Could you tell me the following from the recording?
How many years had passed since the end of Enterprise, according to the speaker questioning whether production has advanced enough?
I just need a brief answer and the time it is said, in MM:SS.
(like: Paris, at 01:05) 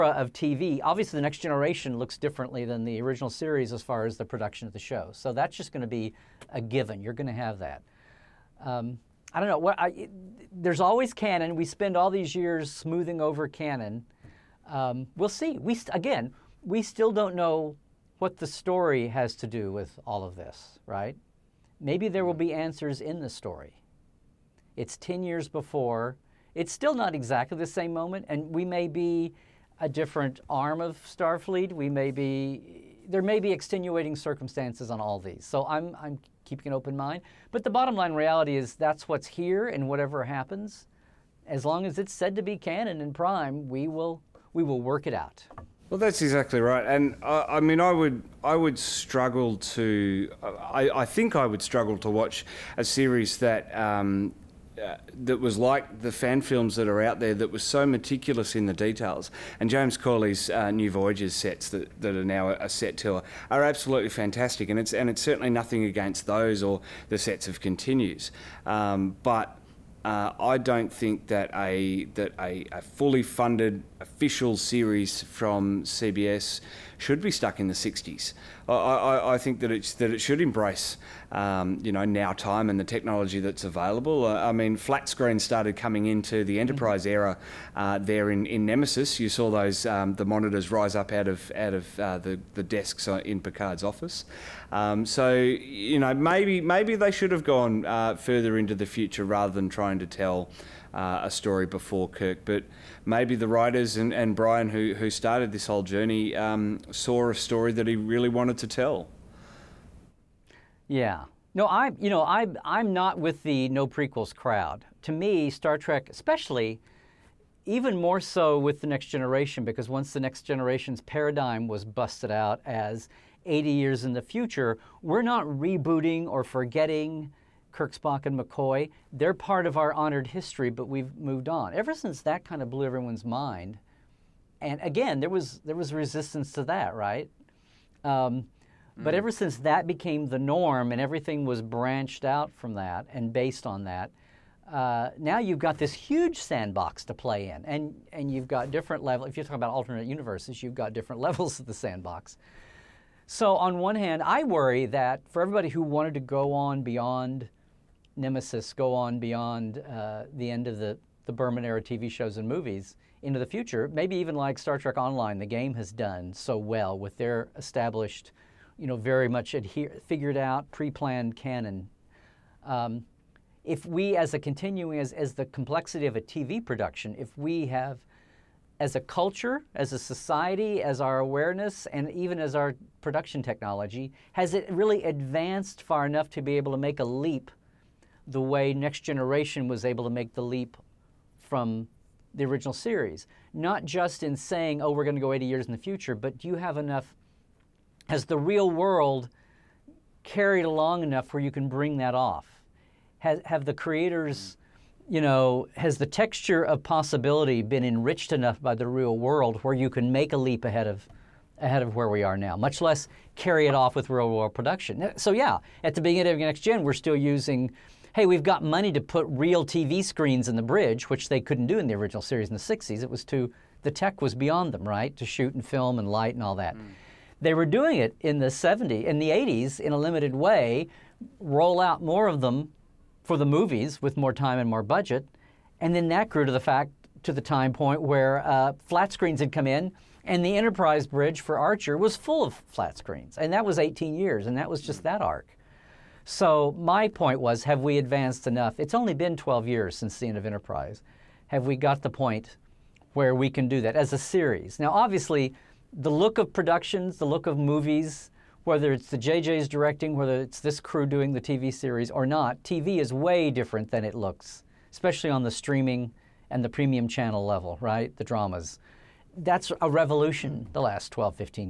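12, at 04:09.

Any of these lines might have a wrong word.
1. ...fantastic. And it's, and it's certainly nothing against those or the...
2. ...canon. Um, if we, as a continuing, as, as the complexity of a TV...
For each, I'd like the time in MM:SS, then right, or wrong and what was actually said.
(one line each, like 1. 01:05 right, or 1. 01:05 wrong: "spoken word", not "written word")
1. 01:04 right
2. 02:51 right.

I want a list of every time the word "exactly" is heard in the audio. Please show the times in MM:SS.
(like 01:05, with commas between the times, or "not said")
00:27, 00:46.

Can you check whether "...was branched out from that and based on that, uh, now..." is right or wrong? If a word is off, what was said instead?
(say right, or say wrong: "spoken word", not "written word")
right.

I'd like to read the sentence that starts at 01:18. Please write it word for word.
I, I, I think that, it's, that it should embrace, um, you know, now time and the technology that's available.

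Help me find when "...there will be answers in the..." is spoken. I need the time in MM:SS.
00:22.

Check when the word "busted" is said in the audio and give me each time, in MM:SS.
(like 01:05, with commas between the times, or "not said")
02:01.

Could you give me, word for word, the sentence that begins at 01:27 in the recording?
era uh, there in, in Nemesis.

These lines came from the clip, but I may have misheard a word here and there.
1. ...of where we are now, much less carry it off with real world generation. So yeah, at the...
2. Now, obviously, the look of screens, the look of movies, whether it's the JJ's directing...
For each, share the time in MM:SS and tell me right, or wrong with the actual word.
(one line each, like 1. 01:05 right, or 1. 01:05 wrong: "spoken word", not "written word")
1. 03:31 wrong: "production", not "generation"
2. 04:14 wrong: "productions", not "screens".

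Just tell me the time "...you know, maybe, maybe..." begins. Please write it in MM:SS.
01:35.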